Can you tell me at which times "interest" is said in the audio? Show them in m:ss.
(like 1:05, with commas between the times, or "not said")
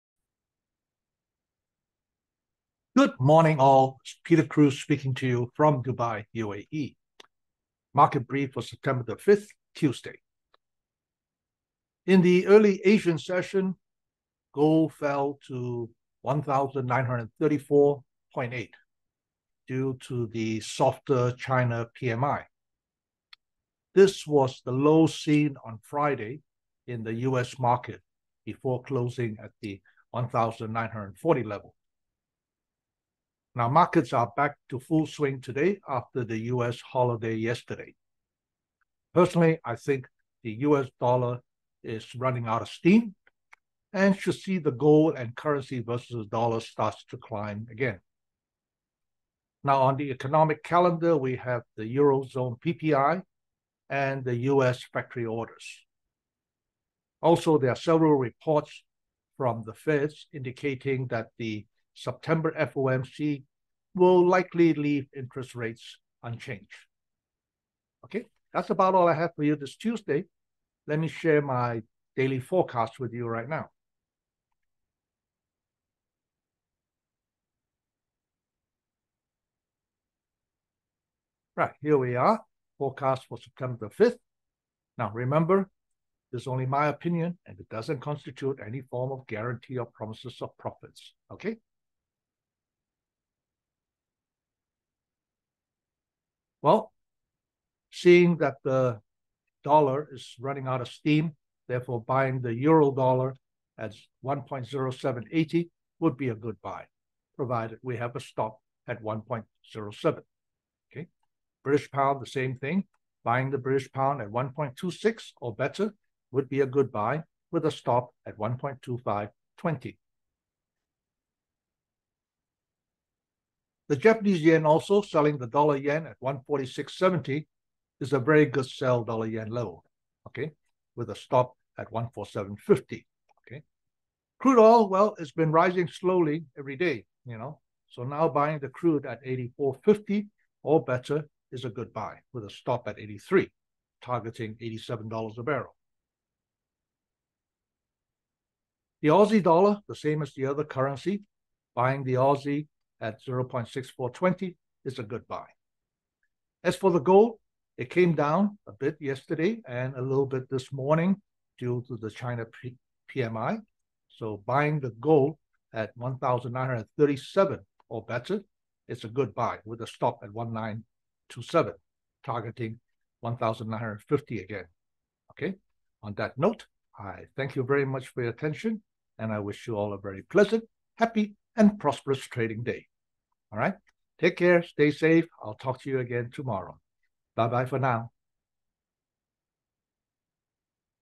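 1:05.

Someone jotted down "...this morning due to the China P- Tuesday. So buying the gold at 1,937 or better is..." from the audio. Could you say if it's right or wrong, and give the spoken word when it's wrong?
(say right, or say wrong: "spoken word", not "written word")
wrong: "PMI", not "Tuesday".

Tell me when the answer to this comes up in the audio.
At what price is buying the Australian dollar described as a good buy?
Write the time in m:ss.
2:33.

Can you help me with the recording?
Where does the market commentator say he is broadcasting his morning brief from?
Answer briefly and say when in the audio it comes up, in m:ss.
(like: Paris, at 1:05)
Dubai, UAE, at 0:05.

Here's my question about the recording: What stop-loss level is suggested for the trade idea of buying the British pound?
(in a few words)
1.2520.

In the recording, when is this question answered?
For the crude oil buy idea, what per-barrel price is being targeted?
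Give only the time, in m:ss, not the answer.
2:24.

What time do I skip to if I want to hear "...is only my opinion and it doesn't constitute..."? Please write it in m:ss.
1:26.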